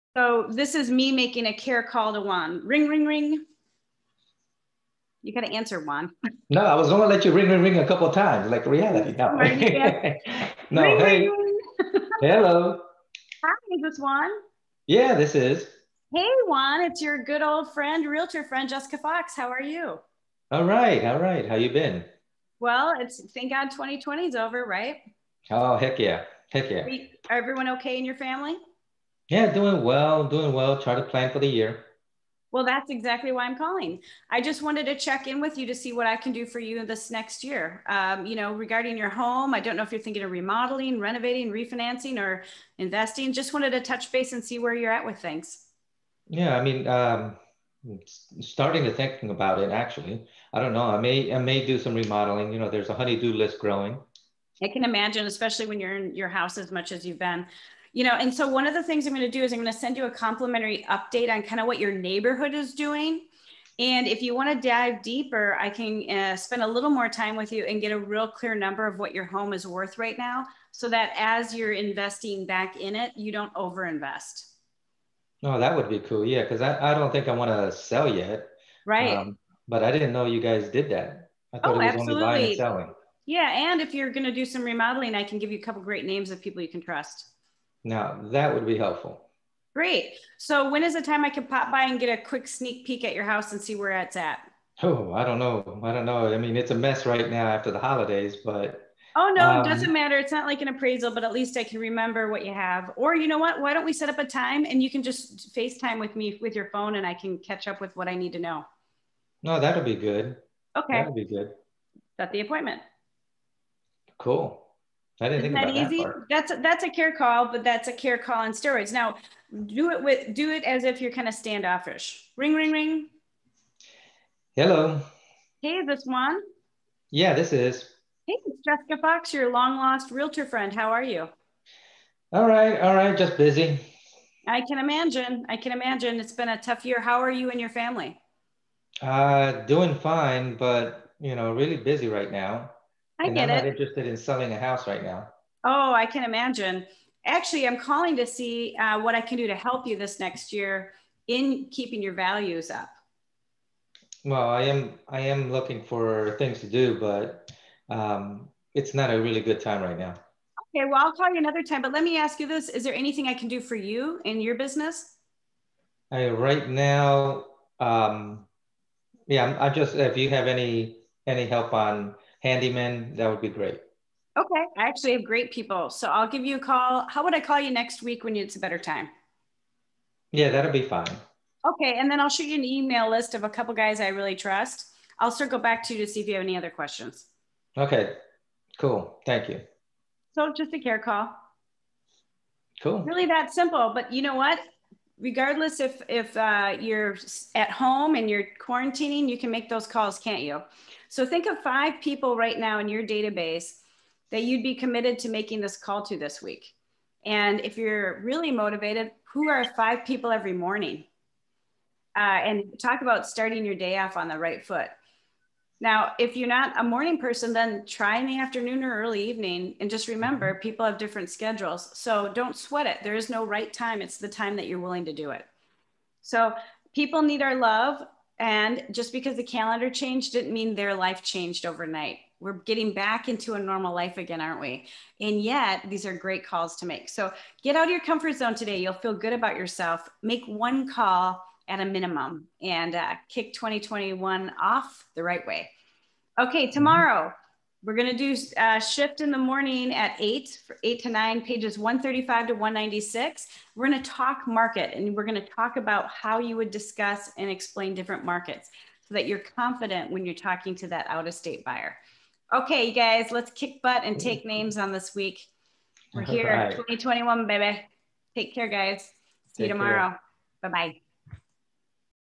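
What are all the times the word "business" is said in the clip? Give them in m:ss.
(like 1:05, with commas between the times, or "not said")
2:44.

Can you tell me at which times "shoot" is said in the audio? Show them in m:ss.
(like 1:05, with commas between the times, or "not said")
3:02.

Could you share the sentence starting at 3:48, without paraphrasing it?
And just because the calendar changed didn't mean their life changed overnight.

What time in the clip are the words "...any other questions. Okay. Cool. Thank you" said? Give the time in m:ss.
3:06.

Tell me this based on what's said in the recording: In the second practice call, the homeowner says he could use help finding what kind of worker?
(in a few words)
handyman.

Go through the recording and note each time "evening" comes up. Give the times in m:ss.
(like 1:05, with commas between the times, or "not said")
3:39.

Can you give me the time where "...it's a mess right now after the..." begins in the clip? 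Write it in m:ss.
1:36.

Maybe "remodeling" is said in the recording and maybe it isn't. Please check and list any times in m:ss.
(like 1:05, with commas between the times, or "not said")
0:40, 0:51, 1:24.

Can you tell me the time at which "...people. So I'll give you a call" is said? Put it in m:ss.
2:55.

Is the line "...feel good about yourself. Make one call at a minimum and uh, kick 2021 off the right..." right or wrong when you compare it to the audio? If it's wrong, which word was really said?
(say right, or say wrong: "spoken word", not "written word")
right.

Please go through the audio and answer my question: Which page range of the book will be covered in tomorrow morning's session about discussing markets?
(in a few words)
135 to 196.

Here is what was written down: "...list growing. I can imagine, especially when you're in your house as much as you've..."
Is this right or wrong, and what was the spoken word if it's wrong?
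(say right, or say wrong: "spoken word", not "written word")
right.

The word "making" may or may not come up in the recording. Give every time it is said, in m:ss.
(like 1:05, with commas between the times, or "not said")
0:01, 3:25.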